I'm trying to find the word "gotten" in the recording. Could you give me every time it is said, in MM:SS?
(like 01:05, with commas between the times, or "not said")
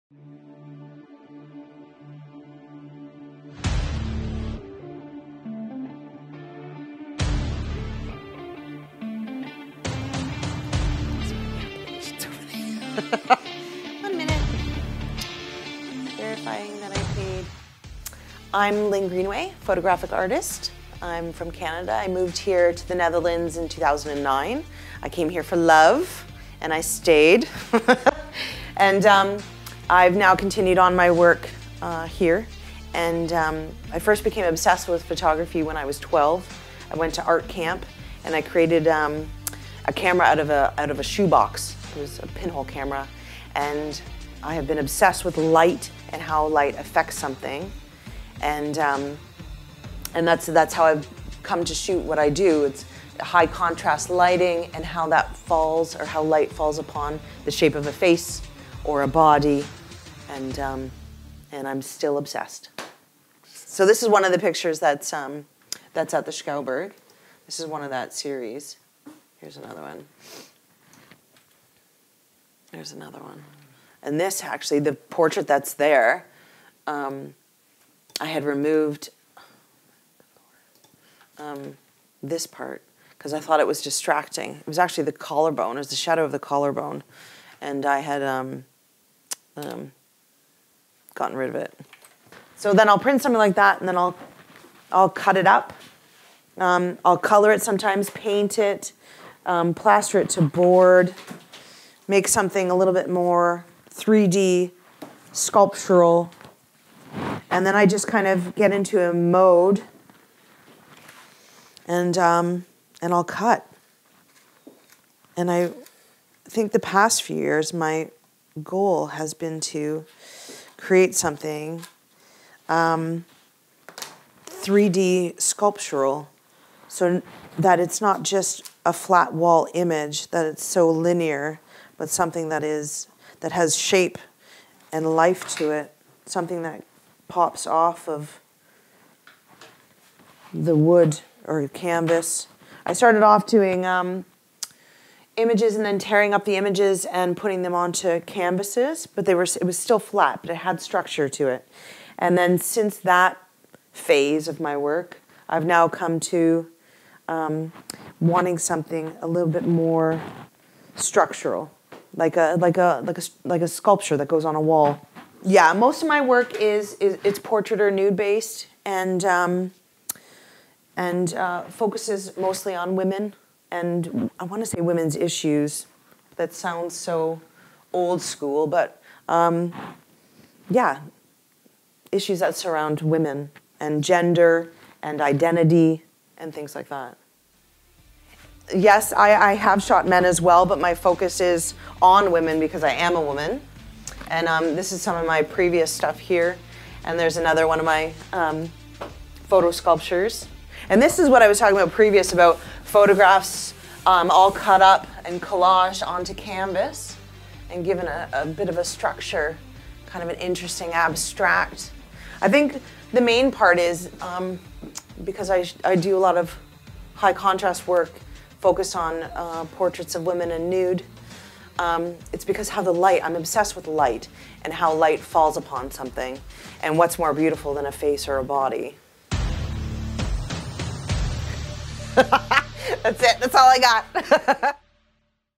01:31.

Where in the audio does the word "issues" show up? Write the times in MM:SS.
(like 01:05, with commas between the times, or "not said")
02:55, 03:02.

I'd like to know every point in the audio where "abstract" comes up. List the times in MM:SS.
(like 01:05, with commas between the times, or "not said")
03:30.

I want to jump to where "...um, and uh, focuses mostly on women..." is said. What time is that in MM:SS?
02:49.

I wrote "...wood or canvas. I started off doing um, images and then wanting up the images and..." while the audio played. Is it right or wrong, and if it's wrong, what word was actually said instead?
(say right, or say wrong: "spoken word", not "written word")
wrong: "tearing", not "wanting".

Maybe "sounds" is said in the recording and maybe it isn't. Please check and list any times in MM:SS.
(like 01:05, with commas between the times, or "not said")
02:56.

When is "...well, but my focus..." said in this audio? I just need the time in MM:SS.
03:10.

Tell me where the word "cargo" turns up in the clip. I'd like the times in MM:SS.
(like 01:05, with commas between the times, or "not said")
not said.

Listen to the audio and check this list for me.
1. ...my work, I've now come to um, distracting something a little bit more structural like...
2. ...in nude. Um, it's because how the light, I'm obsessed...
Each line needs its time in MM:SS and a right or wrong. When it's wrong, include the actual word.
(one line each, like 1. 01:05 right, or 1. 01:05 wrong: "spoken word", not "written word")
1. 02:34 wrong: "wanting", not "distracting"
2. 03:40 right.